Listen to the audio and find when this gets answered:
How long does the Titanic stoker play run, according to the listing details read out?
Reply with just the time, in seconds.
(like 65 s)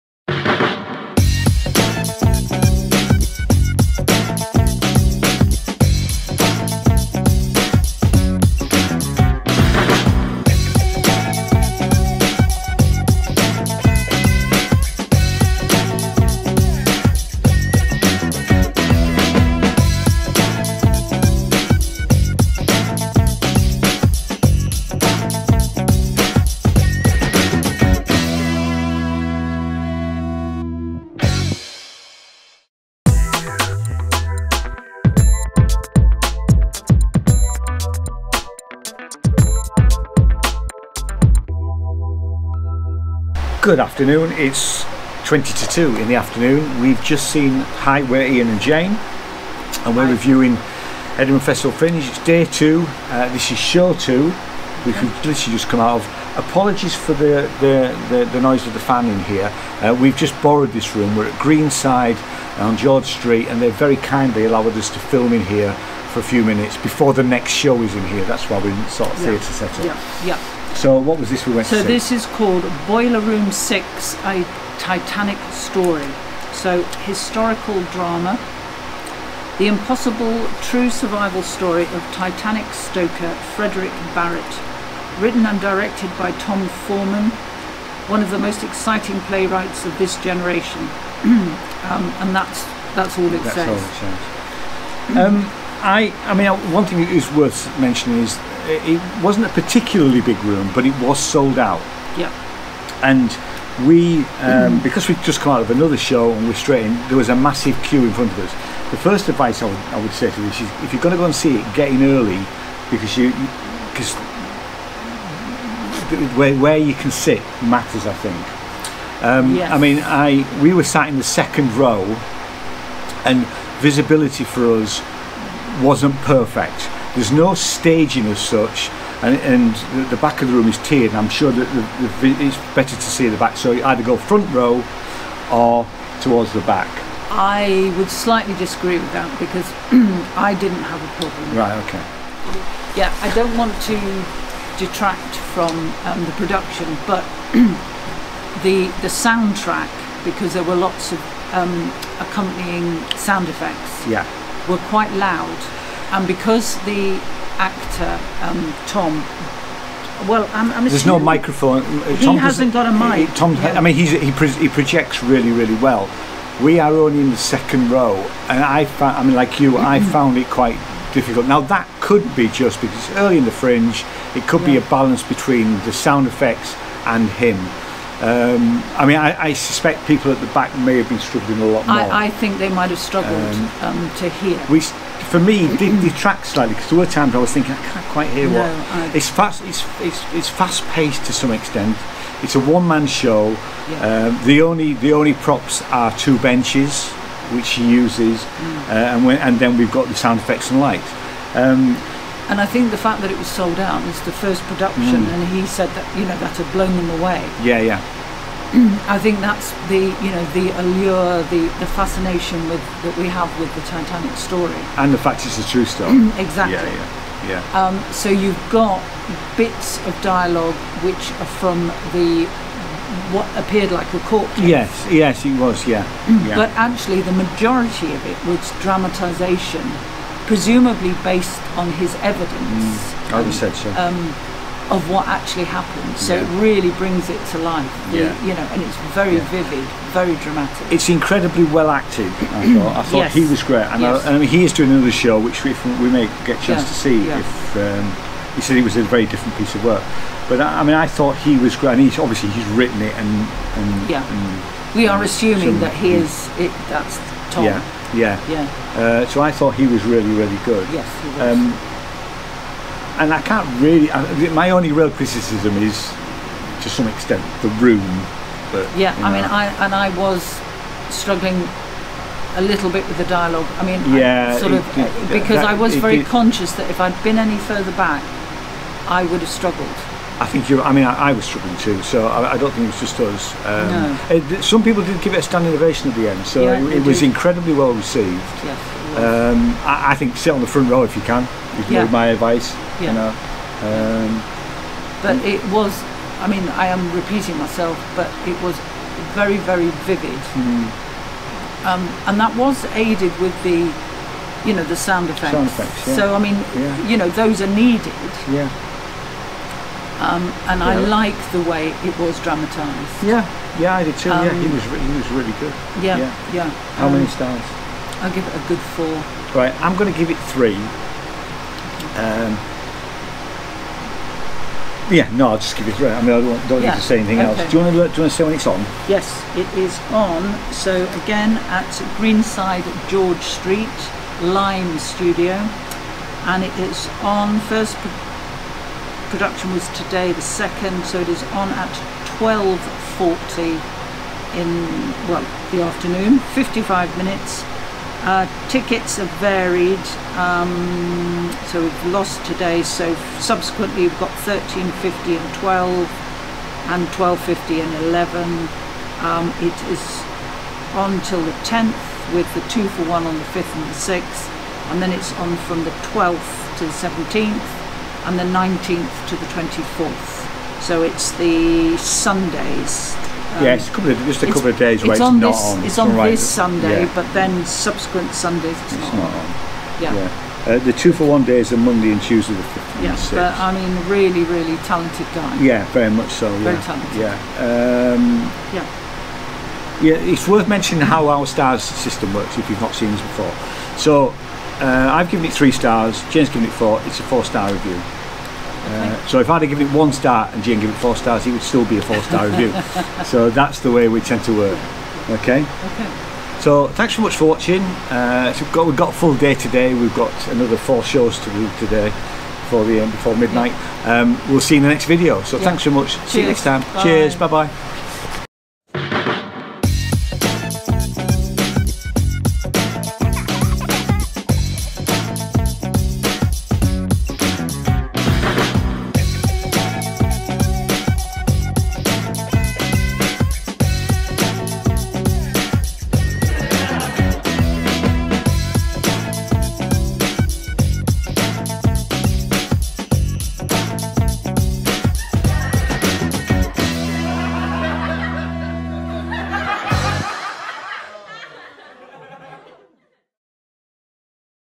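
346 s.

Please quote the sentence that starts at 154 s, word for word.
were quite loud and because the actor um, Tom.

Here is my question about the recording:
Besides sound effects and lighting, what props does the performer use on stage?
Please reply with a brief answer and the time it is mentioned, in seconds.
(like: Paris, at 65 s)
Two benches, at 196 s.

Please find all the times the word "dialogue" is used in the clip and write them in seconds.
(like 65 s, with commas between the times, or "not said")
220 s, 273 s.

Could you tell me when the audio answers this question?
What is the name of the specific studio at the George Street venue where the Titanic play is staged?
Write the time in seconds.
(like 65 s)
334 s.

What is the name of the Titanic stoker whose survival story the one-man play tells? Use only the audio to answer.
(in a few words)
Frederick Barrett.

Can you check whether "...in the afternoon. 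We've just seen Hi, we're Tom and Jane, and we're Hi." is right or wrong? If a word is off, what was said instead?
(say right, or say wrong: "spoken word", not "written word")
wrong: "Ian", not "Tom".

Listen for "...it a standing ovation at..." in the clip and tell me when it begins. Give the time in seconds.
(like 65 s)
285 s.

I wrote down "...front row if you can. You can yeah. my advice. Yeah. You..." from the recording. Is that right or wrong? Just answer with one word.
right.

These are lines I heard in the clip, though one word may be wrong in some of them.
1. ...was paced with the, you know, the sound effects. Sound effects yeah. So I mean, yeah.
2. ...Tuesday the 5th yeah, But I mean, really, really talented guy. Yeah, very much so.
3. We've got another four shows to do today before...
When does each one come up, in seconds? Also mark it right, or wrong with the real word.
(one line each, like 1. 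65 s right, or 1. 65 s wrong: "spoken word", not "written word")
1. 302 s wrong: "aided", not "paced"
2. 382 s right
3. 409 s right.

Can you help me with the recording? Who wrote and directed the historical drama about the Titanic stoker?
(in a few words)
Tom Foreman.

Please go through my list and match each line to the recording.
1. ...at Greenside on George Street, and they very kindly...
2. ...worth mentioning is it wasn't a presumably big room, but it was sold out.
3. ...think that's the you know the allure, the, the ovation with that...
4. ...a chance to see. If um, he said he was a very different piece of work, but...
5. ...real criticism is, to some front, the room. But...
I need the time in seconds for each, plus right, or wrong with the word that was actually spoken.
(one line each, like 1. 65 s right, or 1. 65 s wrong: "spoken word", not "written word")
1. 61 s right
2. 97 s wrong: "particularly", not "presumably"
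3. 209 s wrong: "fascination", not "ovation"
4. 246 s right
5. 264 s wrong: "extent", not "front".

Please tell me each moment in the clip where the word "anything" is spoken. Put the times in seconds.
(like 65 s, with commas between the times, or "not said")
327 s.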